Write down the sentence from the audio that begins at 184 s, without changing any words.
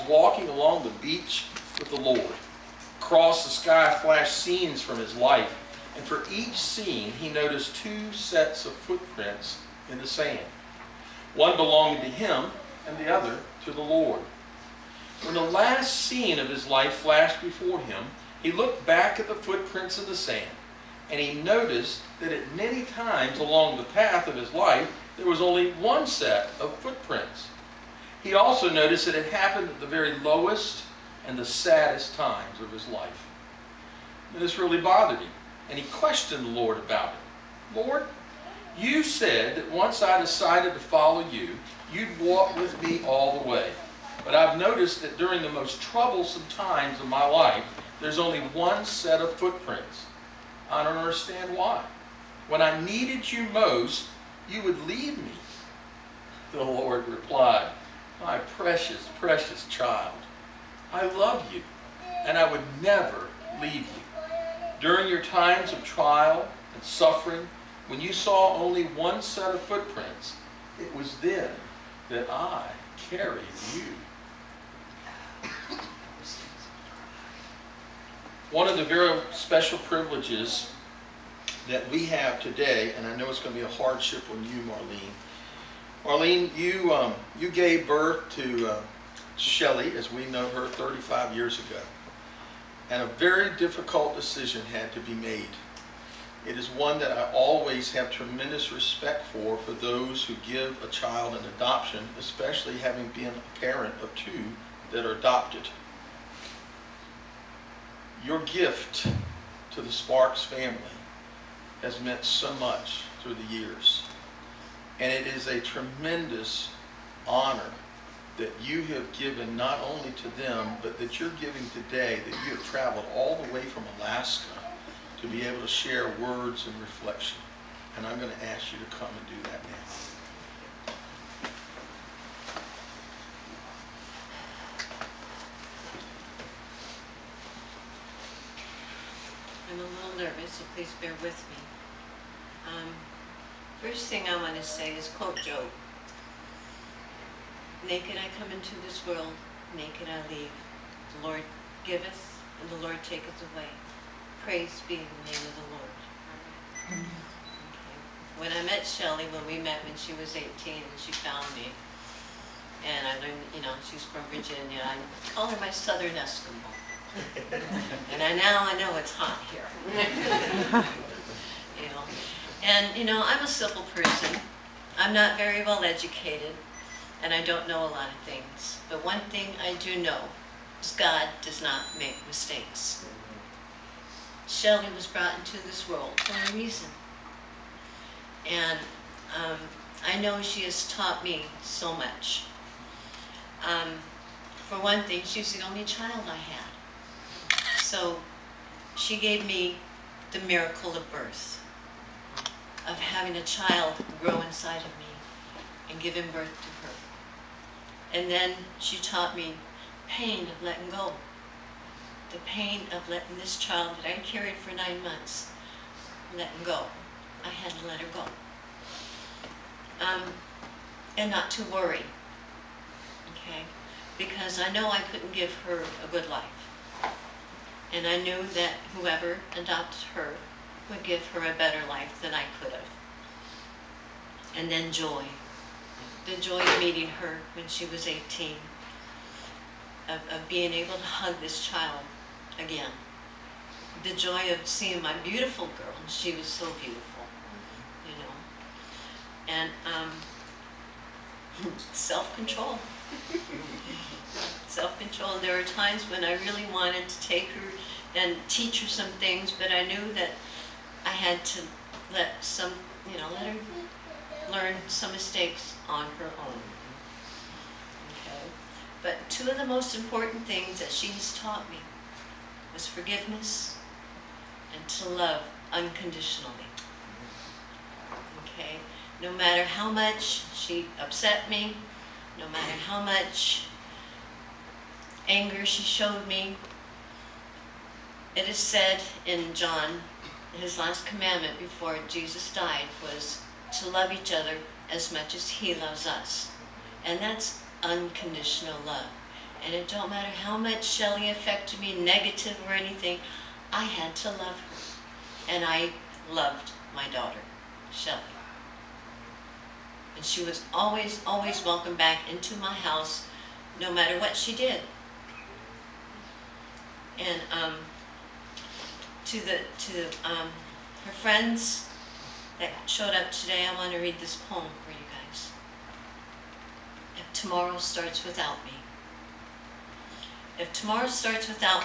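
Shelley was brought into this world for a reason.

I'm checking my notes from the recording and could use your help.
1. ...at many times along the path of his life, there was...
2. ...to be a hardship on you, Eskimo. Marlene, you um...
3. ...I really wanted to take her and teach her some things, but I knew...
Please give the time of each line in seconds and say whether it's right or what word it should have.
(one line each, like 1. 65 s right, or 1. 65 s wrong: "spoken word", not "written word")
1. 22 s right
2. 83 s wrong: "Marlene", not "Eskimo"
3. 256 s right.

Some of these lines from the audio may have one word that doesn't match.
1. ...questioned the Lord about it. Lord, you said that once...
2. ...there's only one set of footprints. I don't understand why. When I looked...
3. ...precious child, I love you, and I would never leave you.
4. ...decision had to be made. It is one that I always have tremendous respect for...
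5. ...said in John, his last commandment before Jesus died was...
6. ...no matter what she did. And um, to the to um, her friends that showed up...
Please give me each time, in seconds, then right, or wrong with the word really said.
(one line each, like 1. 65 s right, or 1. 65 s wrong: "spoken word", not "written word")
1. 35 s right
2. 48 s wrong: "needed", not "looked"
3. 59 s right
4. 94 s right
5. 288 s right
6. 313 s right.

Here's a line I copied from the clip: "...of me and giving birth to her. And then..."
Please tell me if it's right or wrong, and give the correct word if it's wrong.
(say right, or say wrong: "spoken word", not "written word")
right.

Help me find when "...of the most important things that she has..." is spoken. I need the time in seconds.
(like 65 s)
269 s.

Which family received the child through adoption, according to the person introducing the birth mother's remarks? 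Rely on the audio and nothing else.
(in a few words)
Sparks.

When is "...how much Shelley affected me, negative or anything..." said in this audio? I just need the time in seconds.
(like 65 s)
300 s.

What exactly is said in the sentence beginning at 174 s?
I'm not very well educated, and I don't know a lot of things.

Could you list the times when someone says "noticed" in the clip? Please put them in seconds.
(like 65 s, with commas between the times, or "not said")
7 s, 21 s, 28 s, 44 s.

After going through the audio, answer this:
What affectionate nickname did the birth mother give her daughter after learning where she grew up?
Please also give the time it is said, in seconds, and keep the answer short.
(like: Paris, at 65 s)
Southern Eskimo, at 165 s.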